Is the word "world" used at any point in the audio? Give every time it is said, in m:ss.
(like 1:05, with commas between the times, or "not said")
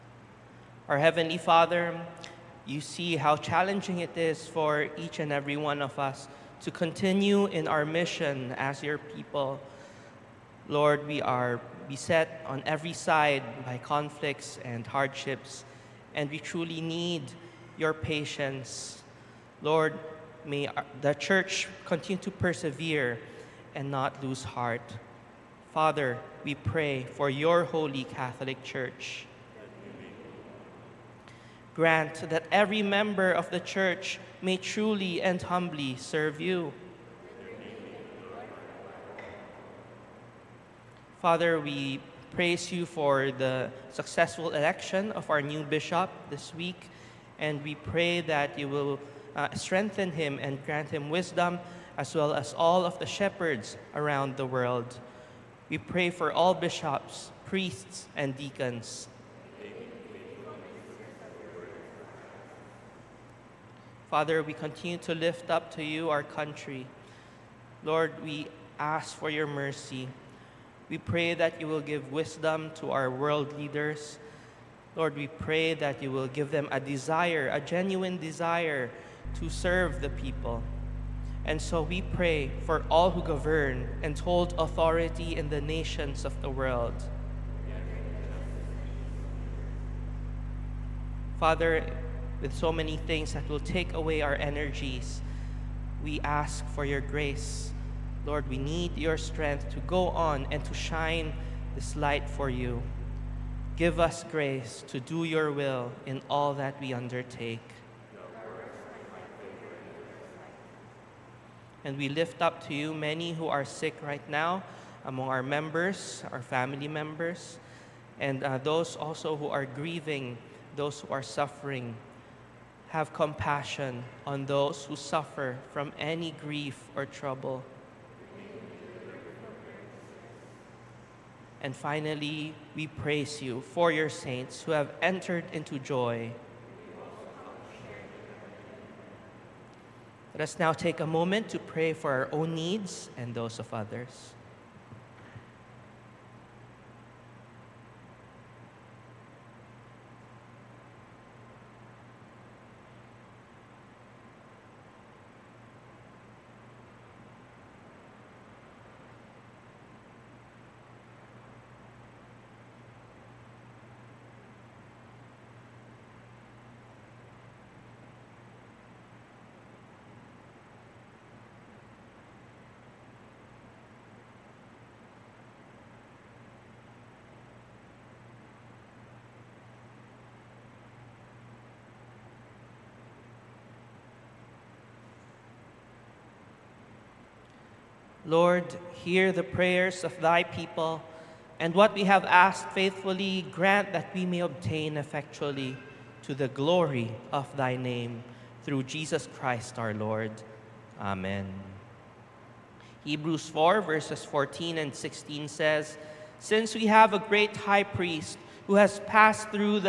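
0:54, 1:13, 1:26.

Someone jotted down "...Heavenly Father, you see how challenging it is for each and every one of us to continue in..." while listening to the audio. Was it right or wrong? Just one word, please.
right.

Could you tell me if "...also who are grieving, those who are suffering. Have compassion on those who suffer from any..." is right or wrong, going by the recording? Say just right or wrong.
right.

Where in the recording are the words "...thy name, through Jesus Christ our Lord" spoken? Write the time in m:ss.
3:17.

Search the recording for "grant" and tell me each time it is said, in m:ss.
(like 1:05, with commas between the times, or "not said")
0:31, 0:50, 3:13.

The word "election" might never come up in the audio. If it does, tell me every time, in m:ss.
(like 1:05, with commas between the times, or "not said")
0:44.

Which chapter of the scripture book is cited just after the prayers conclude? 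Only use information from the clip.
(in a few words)
4.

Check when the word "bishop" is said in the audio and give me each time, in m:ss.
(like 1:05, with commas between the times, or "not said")
0:45, 0:56.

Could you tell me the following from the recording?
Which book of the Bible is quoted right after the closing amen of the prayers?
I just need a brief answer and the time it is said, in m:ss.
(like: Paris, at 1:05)
Hebrews, at 3:23.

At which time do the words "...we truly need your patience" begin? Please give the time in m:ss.
0:16.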